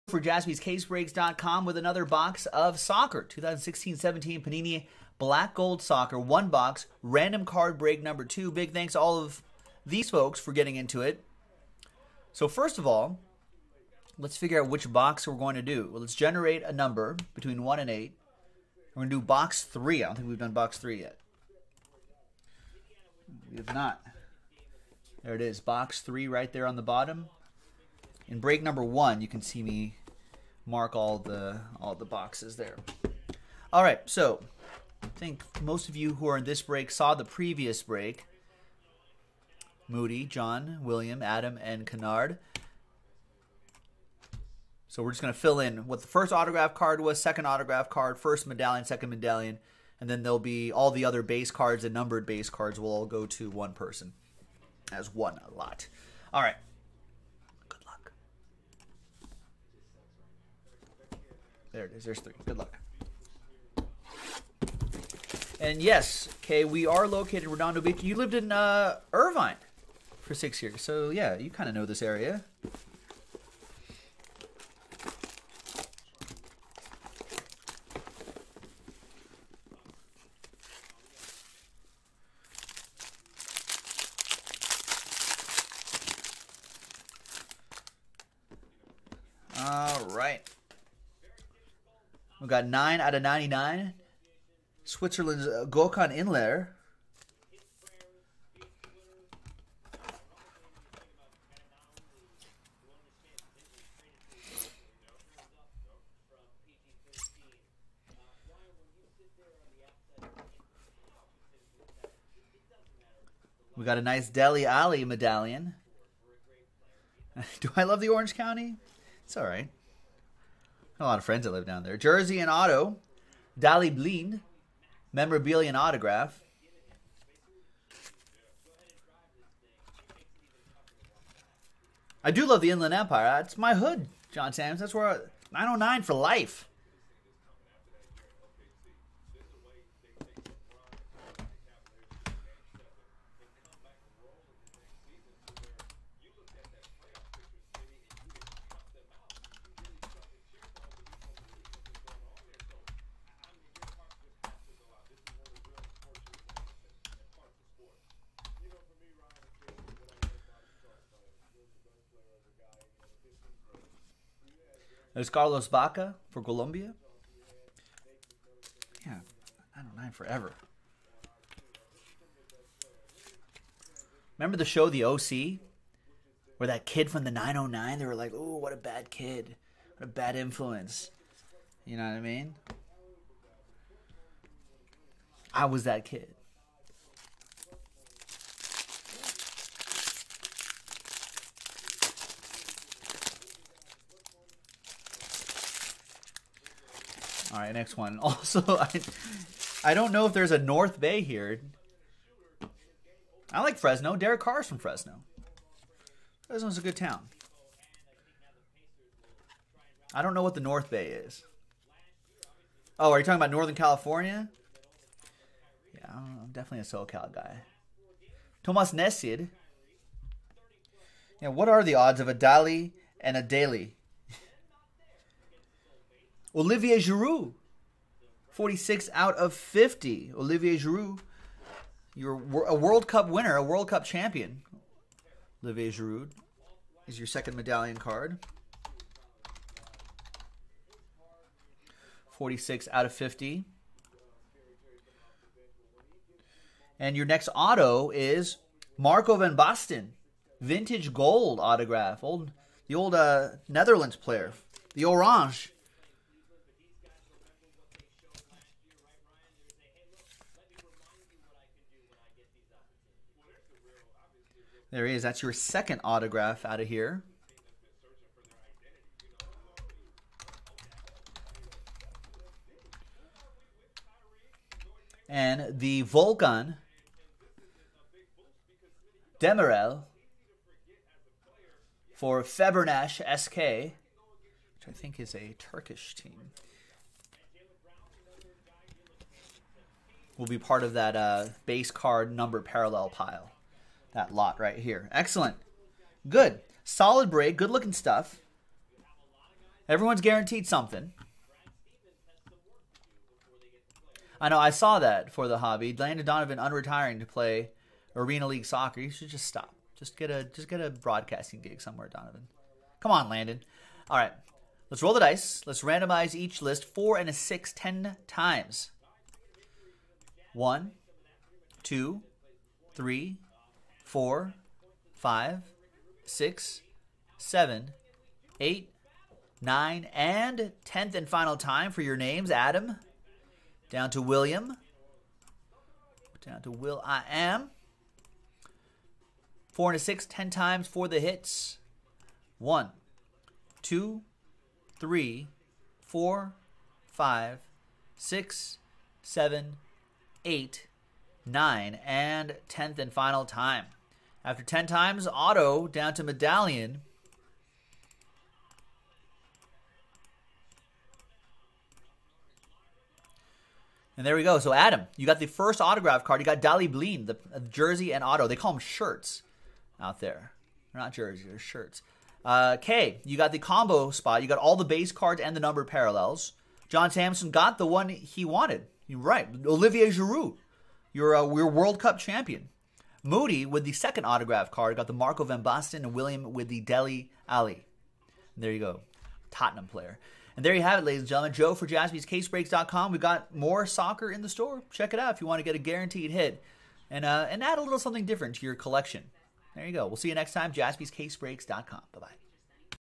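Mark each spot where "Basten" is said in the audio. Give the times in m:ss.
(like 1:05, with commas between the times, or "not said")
4:09, 6:25.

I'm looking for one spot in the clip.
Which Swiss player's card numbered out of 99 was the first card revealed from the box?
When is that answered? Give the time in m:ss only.
1:35.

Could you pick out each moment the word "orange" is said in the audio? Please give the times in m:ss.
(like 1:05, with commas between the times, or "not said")
1:58, 4:15.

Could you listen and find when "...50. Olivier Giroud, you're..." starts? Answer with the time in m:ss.
3:49.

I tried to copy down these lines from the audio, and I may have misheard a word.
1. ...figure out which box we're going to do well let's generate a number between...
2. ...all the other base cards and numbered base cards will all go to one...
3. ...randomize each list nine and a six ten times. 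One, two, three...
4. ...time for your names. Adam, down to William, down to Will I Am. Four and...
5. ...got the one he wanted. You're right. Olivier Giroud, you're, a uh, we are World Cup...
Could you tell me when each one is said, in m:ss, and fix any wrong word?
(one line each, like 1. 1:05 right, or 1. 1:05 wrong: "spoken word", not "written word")
1. 0:14 right
2. 0:50 right
3. 5:15 wrong: "four", not "nine"
4. 5:31 right
5. 6:17 right.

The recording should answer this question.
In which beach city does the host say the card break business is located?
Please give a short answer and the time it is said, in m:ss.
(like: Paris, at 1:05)
Redondo Beach, at 1:07.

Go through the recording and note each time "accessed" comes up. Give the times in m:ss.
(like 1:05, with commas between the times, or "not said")
not said.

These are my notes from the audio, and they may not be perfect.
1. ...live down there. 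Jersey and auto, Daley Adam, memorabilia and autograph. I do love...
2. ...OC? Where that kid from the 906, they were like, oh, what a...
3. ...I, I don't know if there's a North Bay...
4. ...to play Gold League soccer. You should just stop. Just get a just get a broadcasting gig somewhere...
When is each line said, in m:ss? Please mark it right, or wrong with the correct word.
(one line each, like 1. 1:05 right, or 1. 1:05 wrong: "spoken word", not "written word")
1. 2:01 wrong: "Blind", not "Adam"
2. 2:55 wrong: "909", not "906"
3. 3:18 right
4. 5:07 wrong: "Arena", not "Gold".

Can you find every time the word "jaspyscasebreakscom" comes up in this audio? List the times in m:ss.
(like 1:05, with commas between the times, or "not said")
0:00, 6:31, 6:40.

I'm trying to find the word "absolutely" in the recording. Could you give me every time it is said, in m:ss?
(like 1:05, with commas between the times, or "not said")
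not said.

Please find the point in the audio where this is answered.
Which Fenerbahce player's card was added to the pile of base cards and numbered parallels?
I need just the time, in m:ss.
4:36.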